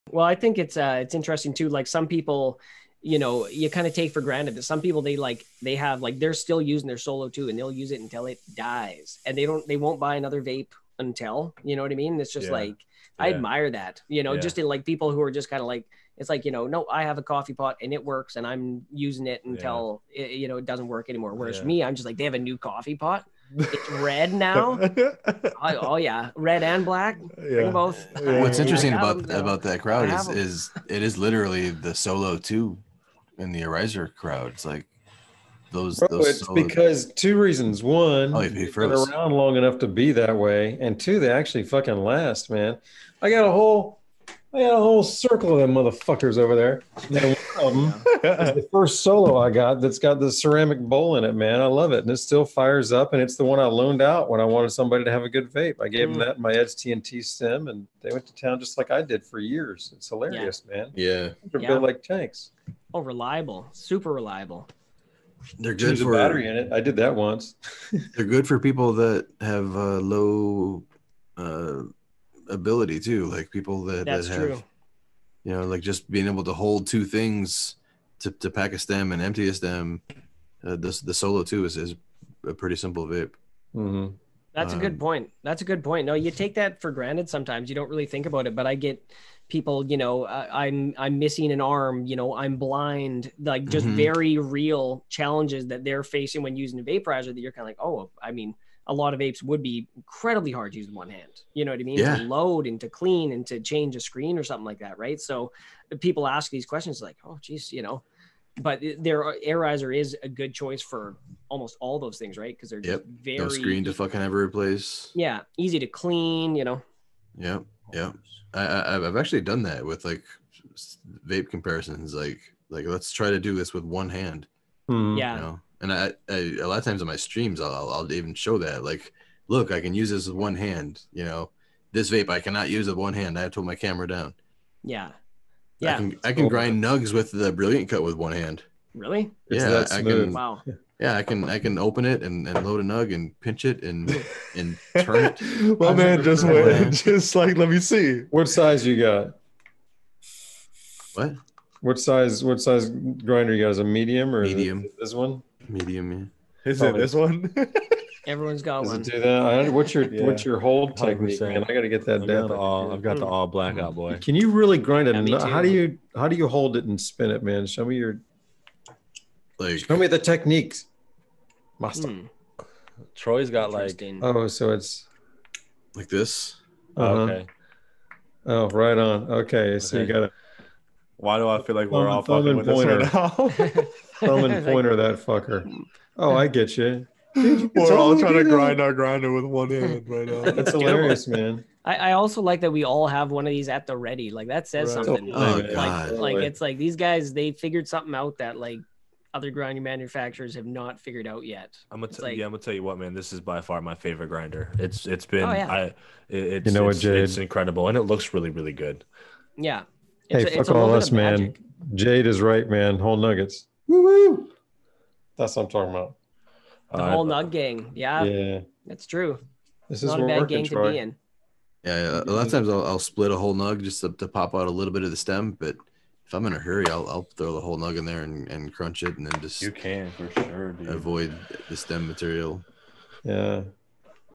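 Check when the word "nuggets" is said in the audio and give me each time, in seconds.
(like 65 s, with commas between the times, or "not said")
213 s.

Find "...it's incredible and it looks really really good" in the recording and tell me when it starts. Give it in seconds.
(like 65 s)
207 s.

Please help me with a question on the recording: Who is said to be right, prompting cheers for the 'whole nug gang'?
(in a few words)
Jade.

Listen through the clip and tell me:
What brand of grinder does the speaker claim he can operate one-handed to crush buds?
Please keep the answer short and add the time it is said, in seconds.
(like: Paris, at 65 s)
Brilliant Cut, at 137 s.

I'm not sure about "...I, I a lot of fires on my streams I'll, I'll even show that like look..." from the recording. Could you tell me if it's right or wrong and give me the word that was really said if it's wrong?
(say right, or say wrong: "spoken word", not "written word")
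wrong: "times", not "fires".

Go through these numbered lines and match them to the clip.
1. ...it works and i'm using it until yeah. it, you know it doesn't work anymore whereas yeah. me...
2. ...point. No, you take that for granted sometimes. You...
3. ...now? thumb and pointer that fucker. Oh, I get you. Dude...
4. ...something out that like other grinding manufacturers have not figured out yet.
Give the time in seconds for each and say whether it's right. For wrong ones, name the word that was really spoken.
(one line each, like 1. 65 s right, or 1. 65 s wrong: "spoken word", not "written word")
1. 17 s right
2. 85 s right
3. 183 s right
4. 197 s right.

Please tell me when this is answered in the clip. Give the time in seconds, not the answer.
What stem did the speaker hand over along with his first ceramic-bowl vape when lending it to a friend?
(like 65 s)
56 s.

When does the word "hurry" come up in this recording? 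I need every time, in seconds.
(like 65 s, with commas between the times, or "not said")
226 s.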